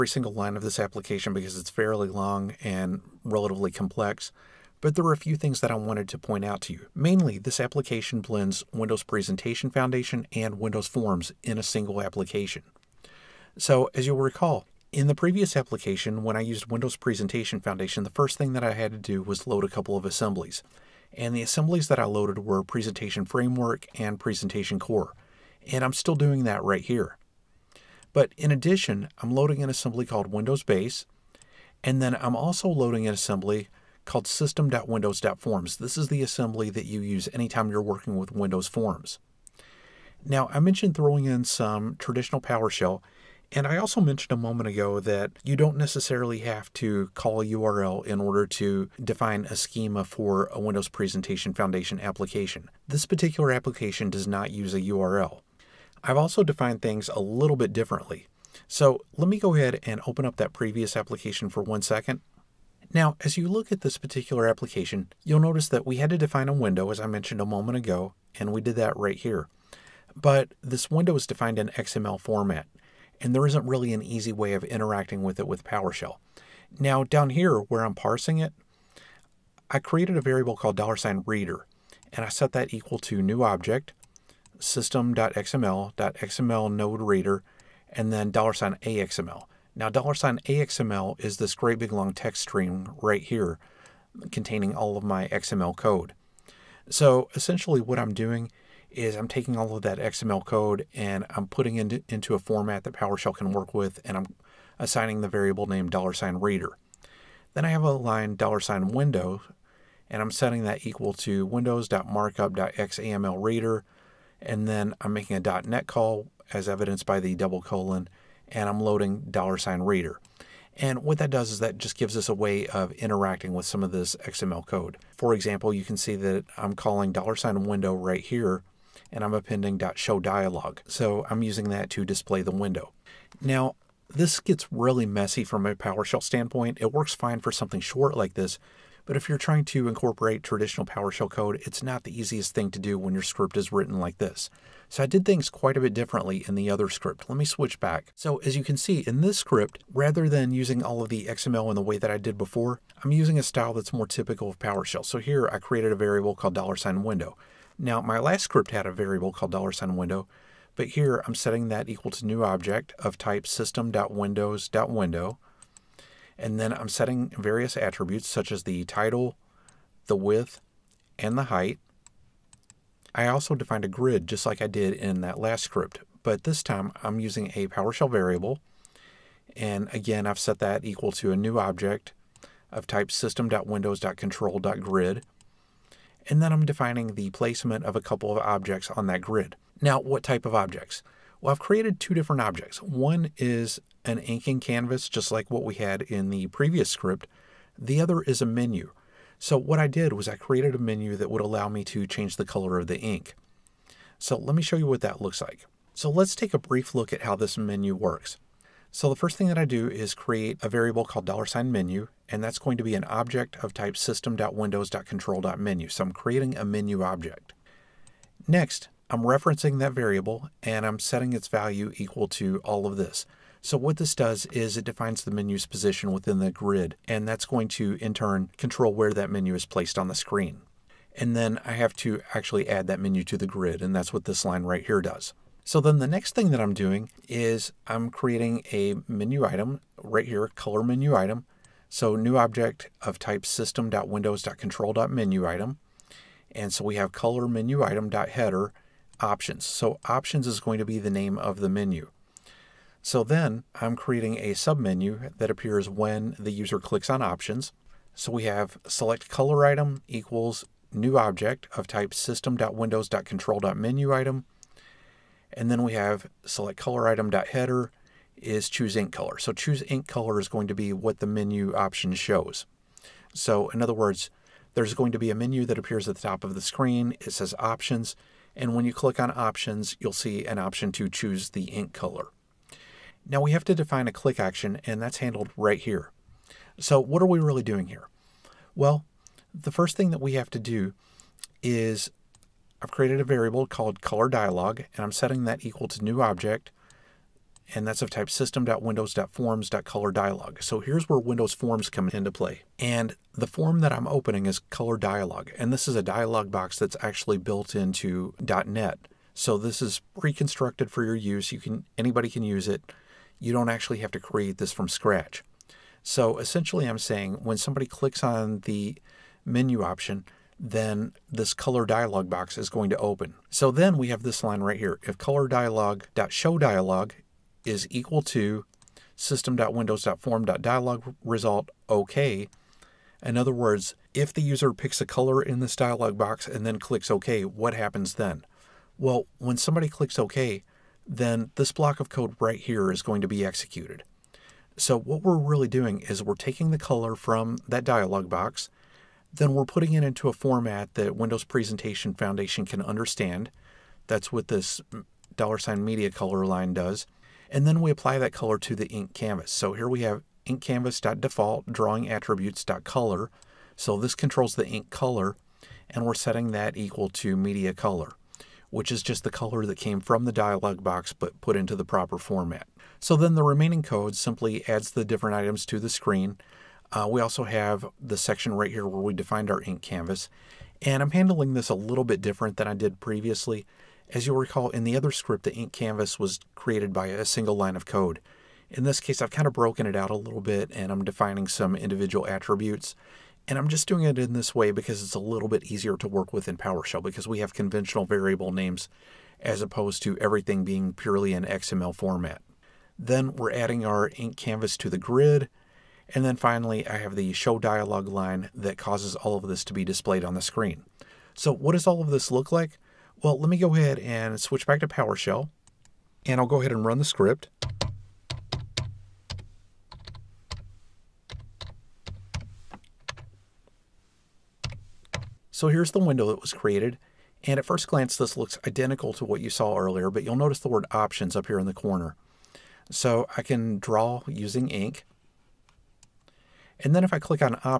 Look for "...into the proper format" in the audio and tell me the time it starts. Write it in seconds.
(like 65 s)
371 s.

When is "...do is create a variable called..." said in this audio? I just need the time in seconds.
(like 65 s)
209 s.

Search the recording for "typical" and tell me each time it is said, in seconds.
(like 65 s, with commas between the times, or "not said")
154 s.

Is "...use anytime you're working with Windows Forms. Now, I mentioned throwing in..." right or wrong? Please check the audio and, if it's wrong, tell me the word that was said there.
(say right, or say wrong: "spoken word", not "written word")
right.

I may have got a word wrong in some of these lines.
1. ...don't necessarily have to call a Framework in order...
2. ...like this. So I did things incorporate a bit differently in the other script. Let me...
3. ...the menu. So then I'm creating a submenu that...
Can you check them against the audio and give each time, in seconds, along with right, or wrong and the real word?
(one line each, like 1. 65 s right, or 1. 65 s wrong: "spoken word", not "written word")
1. 45 s wrong: "URL", not "Framework"
2. 143 s wrong: "quite", not "incorporate"
3. 251 s right.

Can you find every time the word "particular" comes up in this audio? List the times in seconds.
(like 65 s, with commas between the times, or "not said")
53 s, 63 s.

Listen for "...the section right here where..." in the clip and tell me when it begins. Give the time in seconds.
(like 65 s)
378 s.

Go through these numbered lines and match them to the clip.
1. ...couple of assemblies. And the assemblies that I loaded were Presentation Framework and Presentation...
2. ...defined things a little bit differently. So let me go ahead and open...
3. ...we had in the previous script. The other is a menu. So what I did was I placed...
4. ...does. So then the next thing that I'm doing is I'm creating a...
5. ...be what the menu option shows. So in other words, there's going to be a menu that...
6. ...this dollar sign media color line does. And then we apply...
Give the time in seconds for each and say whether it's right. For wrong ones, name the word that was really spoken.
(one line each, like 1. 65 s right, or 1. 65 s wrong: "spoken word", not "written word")
1. 19 s right
2. 56 s right
3. 195 s wrong: "created", not "placed"
4. 235 s right
5. 270 s right
6. 354 s right.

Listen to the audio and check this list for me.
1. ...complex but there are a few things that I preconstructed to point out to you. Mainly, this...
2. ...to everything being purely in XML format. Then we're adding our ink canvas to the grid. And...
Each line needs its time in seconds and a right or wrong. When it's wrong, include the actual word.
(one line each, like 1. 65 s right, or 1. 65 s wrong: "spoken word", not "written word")
1. 3 s wrong: "wanted", not "preconstructed"
2. 400 s right.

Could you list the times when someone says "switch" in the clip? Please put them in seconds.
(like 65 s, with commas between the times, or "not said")
147 s, 414 s.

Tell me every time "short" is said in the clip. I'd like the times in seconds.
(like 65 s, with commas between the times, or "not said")
137 s.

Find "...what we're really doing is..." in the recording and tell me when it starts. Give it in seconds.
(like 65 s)
344 s.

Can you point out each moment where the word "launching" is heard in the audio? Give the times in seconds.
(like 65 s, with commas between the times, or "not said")
not said.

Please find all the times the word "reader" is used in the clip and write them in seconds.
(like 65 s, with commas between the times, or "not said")
81 s, 87 s, 106 s, 113 s, 119 s.